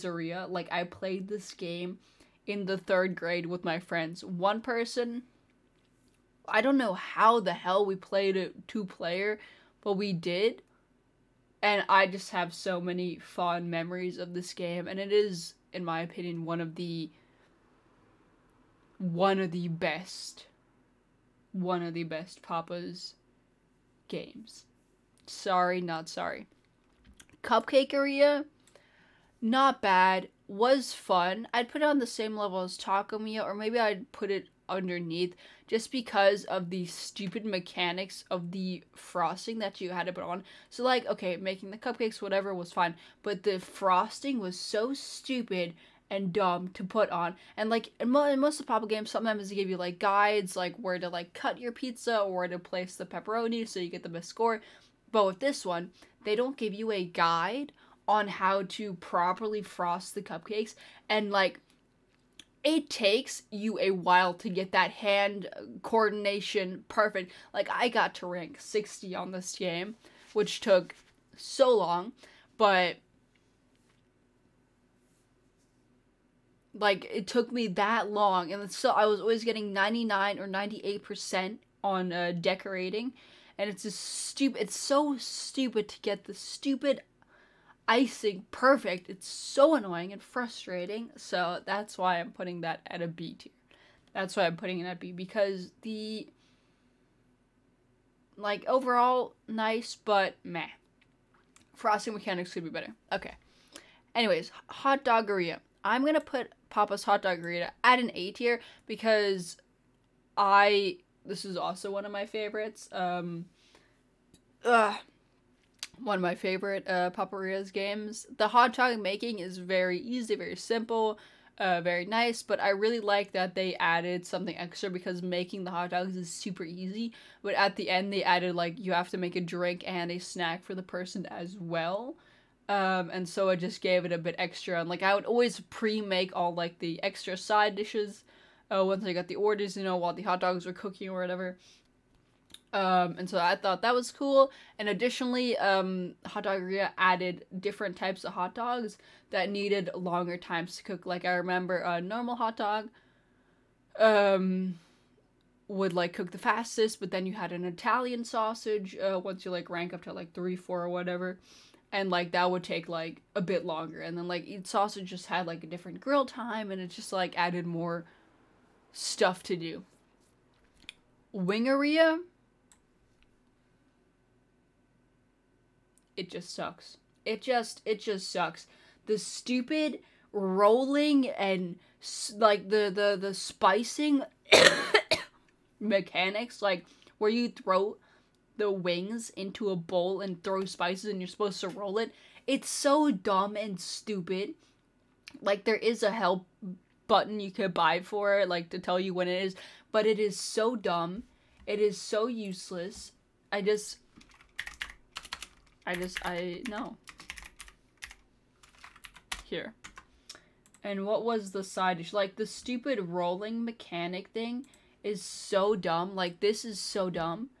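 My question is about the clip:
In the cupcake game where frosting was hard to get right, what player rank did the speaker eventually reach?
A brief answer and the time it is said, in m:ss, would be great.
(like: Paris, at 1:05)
60, at 1:08.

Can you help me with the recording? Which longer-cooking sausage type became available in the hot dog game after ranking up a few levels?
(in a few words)
Italian sausage.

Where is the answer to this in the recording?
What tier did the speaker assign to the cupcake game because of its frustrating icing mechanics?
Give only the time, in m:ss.
1:33.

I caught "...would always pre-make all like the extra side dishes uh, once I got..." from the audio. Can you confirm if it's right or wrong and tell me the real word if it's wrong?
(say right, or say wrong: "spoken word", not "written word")
right.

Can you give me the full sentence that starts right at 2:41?
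And like that would take like a bit longer.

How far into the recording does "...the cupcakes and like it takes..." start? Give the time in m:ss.
1:00.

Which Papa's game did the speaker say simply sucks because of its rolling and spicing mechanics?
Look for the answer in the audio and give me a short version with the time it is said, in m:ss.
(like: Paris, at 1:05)
Wingeria, at 2:51.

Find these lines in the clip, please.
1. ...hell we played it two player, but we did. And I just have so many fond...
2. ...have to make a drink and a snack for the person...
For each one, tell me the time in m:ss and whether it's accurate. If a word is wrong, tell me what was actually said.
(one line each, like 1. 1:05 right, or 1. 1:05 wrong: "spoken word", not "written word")
1. 0:07 right
2. 2:08 right.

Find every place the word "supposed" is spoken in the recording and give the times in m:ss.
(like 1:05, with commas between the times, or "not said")
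3:11.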